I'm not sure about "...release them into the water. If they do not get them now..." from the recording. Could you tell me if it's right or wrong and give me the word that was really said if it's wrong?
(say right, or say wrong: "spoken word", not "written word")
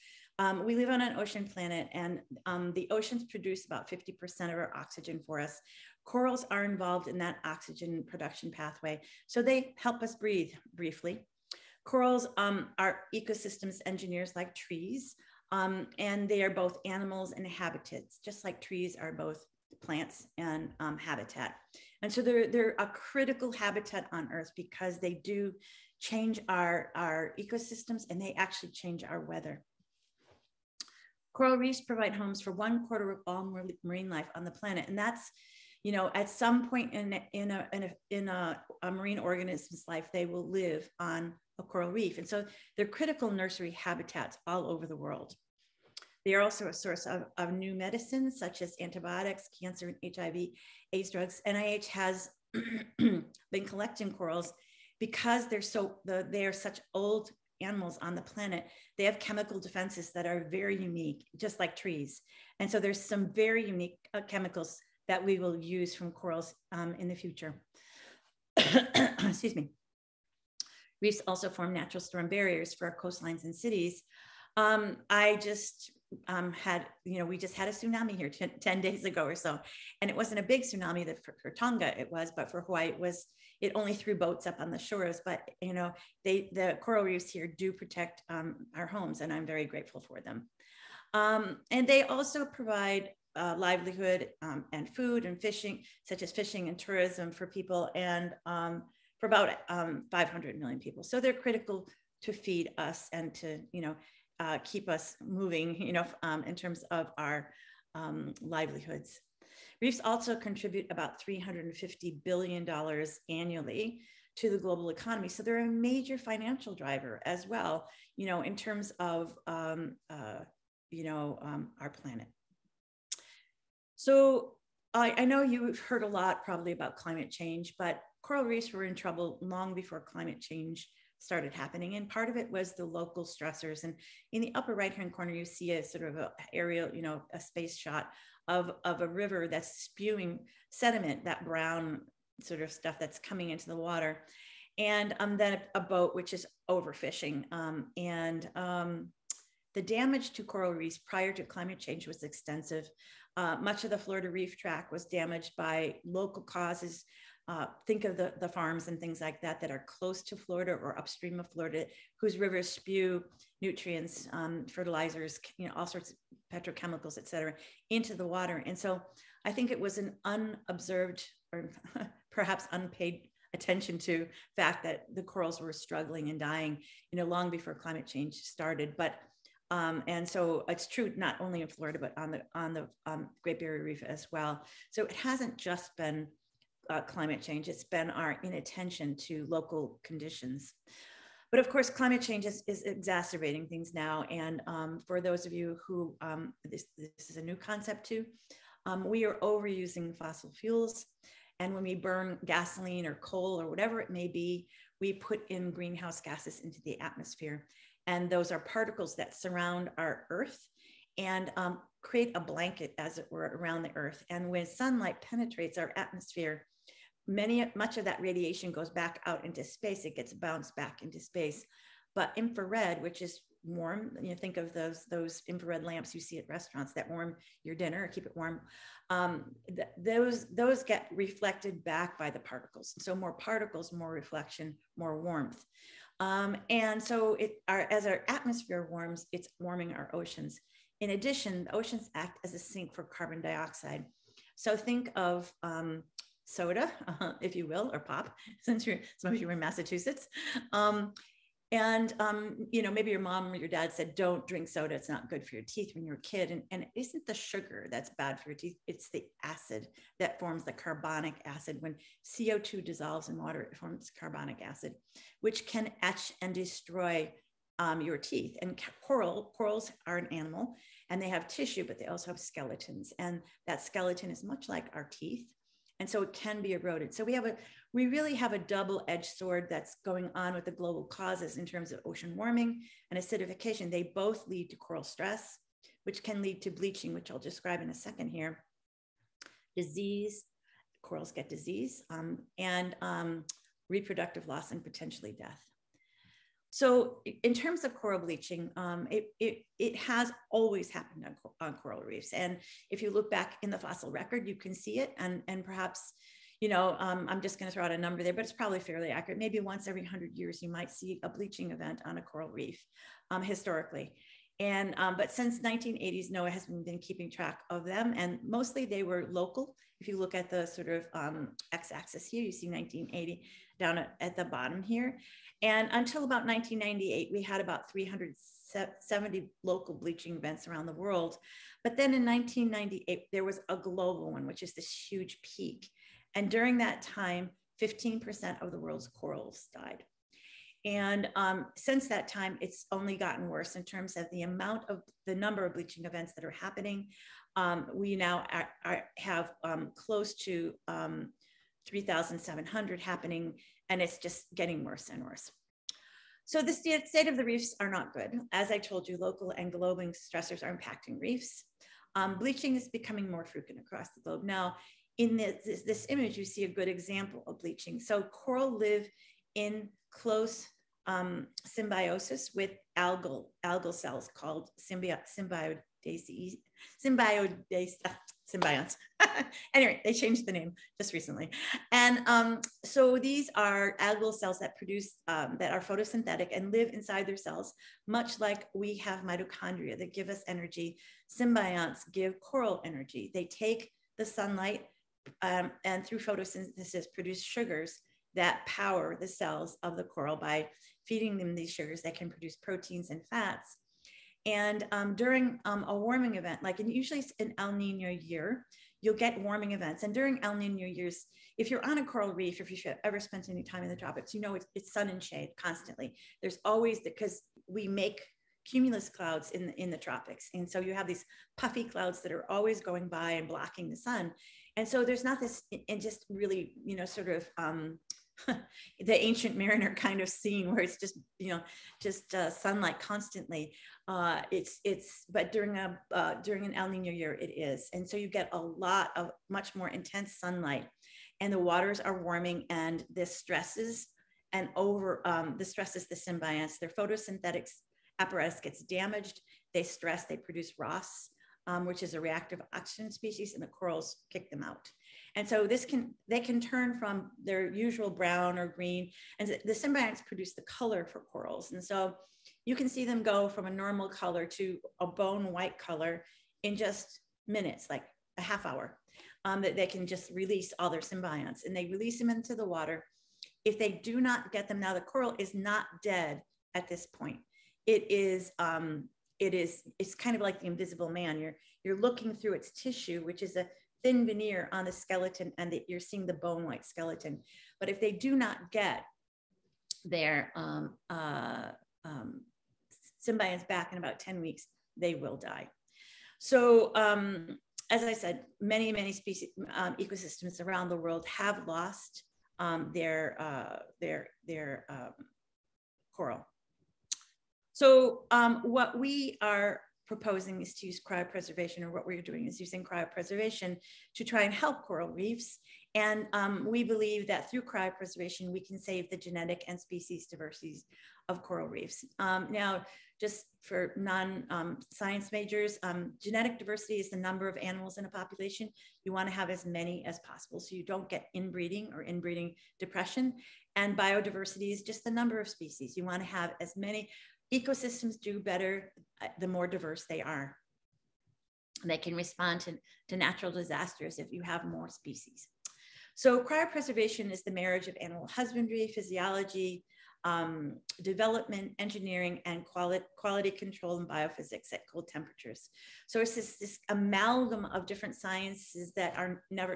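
right.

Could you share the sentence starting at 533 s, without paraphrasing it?
And biodiversity is just the number of species.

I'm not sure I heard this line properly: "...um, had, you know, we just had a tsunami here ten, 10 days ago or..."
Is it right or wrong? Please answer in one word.
right.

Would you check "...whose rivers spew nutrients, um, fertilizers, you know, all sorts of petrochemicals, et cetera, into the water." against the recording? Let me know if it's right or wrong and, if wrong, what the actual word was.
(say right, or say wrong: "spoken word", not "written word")
right.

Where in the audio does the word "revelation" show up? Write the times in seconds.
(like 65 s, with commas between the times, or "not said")
not said.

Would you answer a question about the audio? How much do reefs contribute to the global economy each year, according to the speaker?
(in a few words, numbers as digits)
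$350 billion.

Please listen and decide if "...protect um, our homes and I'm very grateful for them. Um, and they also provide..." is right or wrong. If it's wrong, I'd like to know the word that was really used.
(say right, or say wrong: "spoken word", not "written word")
right.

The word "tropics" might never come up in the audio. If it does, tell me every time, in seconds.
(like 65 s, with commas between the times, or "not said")
413 s, 419 s.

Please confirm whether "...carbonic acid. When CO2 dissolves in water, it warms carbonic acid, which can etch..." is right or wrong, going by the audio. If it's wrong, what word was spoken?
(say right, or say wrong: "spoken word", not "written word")
wrong: "forms", not "warms".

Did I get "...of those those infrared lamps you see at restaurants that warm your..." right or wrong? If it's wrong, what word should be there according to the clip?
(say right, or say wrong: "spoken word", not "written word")
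right.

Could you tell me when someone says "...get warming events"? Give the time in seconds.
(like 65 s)
409 s.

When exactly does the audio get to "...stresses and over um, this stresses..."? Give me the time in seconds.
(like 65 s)
443 s.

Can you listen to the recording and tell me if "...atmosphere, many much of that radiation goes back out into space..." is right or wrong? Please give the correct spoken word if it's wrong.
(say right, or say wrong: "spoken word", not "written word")
right.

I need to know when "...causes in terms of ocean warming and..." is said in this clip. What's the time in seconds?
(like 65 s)
281 s.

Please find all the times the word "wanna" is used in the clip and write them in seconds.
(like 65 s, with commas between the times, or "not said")
529 s, 536 s.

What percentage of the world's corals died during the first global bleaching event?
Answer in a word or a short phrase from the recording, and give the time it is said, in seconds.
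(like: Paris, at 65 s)
15%, at 337 s.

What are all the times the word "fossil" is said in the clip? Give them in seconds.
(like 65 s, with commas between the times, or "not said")
200 s, 303 s.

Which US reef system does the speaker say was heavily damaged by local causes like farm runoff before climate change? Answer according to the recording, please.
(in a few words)
Florida reef tract.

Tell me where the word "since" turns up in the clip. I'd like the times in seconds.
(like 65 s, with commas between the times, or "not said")
248 s, 315 s, 341 s.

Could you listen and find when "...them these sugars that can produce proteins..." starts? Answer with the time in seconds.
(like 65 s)
401 s.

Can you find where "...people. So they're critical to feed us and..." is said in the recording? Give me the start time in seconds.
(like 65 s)
100 s.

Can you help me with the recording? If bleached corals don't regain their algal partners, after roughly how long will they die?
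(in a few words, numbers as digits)
10 weeks.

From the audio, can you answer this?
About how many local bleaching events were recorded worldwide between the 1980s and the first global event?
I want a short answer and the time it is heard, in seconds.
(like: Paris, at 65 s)
370, at 327 s.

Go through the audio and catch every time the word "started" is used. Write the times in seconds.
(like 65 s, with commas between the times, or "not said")
131 s, 178 s.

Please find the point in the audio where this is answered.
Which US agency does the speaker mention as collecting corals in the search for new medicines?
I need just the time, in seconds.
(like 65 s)
51 s.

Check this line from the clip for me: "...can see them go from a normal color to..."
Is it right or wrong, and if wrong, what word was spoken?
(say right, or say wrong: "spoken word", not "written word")
right.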